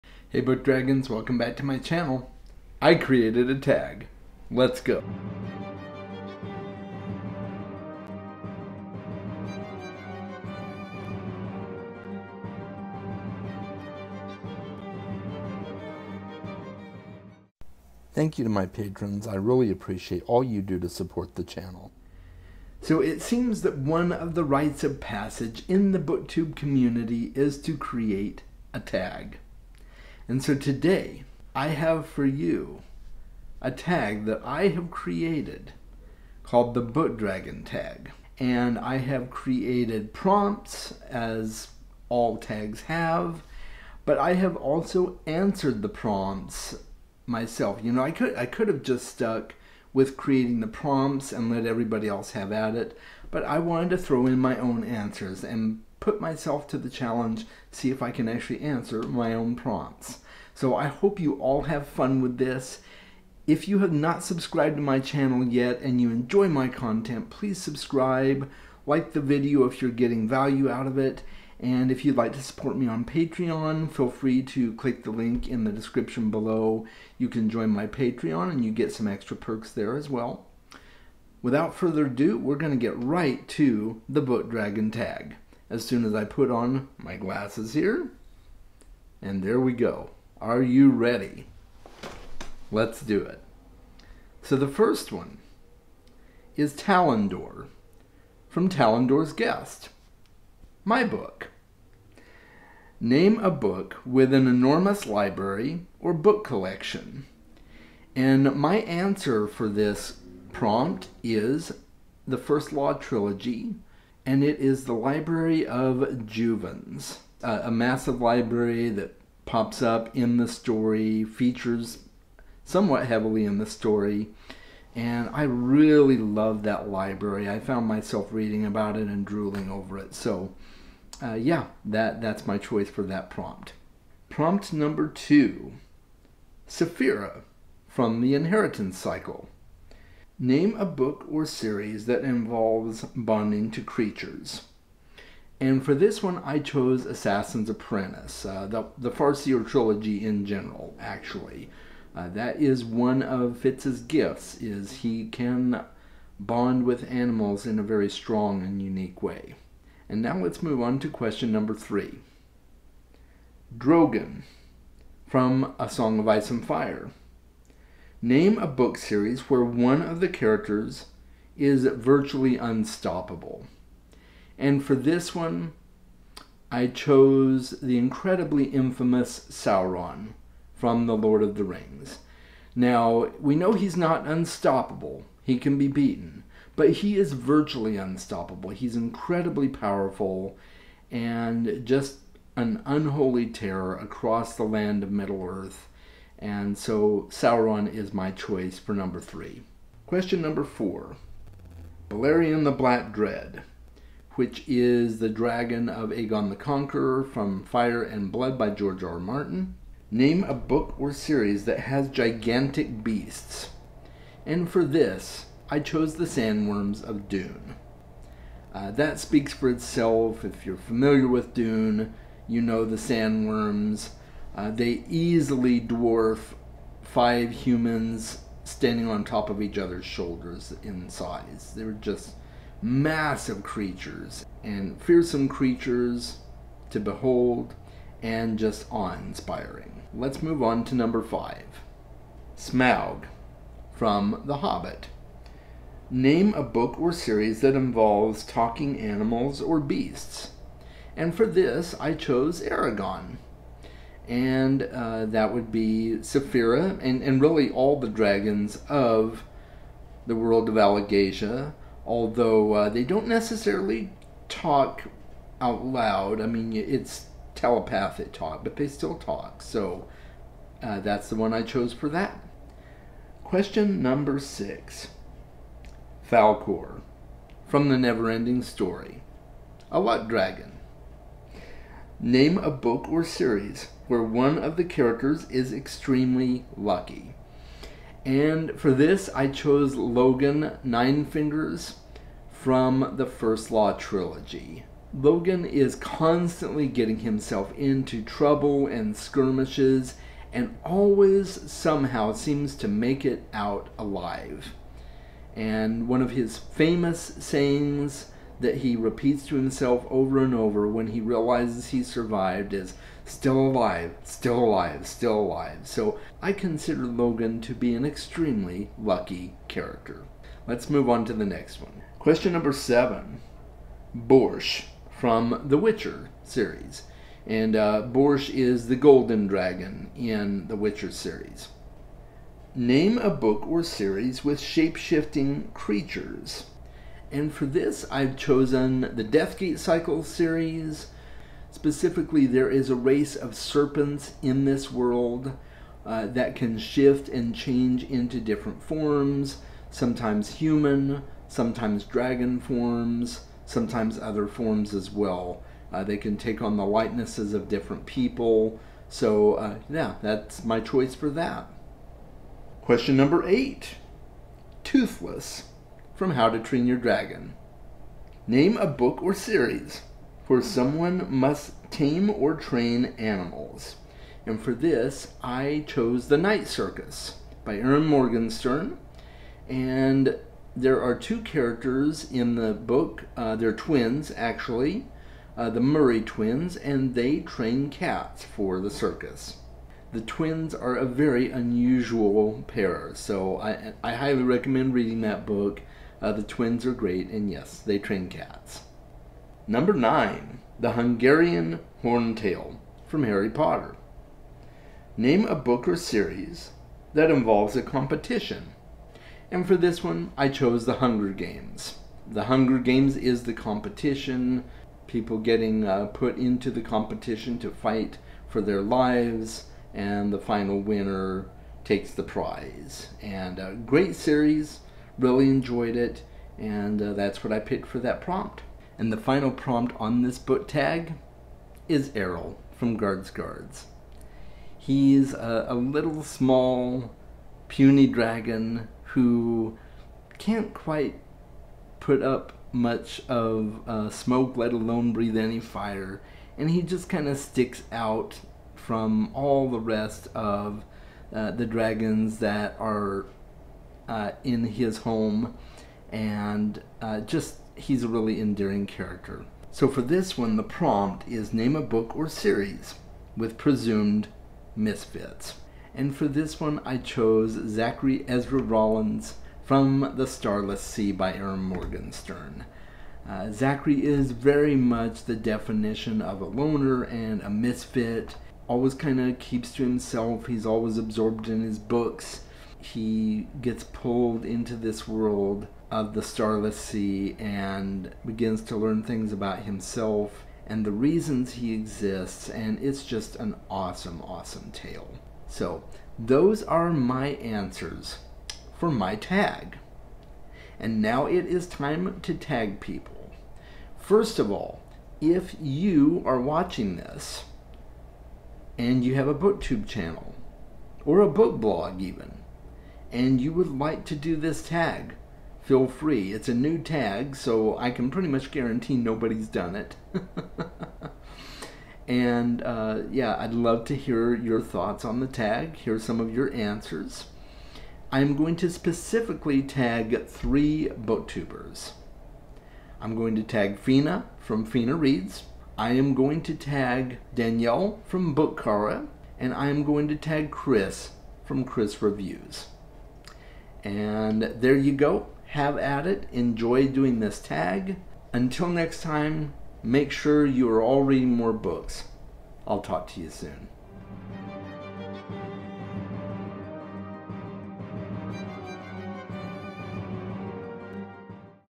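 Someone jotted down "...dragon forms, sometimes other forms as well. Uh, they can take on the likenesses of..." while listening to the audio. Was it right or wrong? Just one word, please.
right.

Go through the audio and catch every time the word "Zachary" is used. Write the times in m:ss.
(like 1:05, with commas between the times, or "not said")
7:47, 7:53.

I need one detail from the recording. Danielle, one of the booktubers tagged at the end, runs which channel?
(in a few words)
Bookchara.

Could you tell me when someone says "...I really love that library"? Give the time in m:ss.
2:05.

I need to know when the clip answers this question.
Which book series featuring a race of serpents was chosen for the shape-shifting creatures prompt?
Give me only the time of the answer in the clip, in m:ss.
5:39.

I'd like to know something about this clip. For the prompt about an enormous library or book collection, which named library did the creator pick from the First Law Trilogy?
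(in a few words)
Library of Juvens.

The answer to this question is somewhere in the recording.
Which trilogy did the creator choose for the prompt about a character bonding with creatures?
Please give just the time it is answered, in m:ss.
2:29.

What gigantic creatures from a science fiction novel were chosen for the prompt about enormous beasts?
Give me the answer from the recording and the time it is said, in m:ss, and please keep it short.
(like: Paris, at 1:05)
Sandworms of Dune, at 3:36.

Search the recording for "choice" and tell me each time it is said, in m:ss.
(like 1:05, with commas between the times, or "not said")
2:12, 3:18, 6:00.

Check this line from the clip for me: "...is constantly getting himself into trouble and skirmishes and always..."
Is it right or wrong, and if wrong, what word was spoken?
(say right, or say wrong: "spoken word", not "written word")
right.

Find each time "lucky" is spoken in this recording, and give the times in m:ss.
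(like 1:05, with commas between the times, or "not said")
4:46, 5:18.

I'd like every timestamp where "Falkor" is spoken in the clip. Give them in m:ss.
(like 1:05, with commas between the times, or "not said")
4:36.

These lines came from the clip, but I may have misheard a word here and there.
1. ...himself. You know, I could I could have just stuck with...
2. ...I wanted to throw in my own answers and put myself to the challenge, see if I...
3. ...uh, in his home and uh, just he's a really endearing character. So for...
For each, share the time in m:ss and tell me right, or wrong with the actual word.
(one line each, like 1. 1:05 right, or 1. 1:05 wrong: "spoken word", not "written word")
1. 0:47 wrong: "myself", not "himself"
2. 0:53 right
3. 7:34 right.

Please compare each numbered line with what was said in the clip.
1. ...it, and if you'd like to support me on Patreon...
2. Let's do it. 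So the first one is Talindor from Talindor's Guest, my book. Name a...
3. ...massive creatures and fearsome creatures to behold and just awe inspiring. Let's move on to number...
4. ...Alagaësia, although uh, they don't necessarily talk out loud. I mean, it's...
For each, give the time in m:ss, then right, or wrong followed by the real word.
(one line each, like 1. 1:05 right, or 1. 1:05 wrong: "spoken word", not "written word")
1. 1:10 right
2. 1:32 right
3. 3:52 right
4. 4:20 right.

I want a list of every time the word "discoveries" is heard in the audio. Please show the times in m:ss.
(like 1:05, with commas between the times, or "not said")
not said.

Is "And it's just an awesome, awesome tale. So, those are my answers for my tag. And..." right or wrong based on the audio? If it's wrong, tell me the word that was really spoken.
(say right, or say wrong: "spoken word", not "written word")
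right.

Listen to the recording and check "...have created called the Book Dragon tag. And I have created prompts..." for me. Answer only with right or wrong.
right.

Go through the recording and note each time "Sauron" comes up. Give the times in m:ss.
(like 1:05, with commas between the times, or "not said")
2:59, 3:17.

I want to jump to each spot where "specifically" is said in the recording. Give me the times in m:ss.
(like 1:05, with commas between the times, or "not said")
5:41, 8:48.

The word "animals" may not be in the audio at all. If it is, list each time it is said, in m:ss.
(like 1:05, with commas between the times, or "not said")
2:37, 4:08, 6:13.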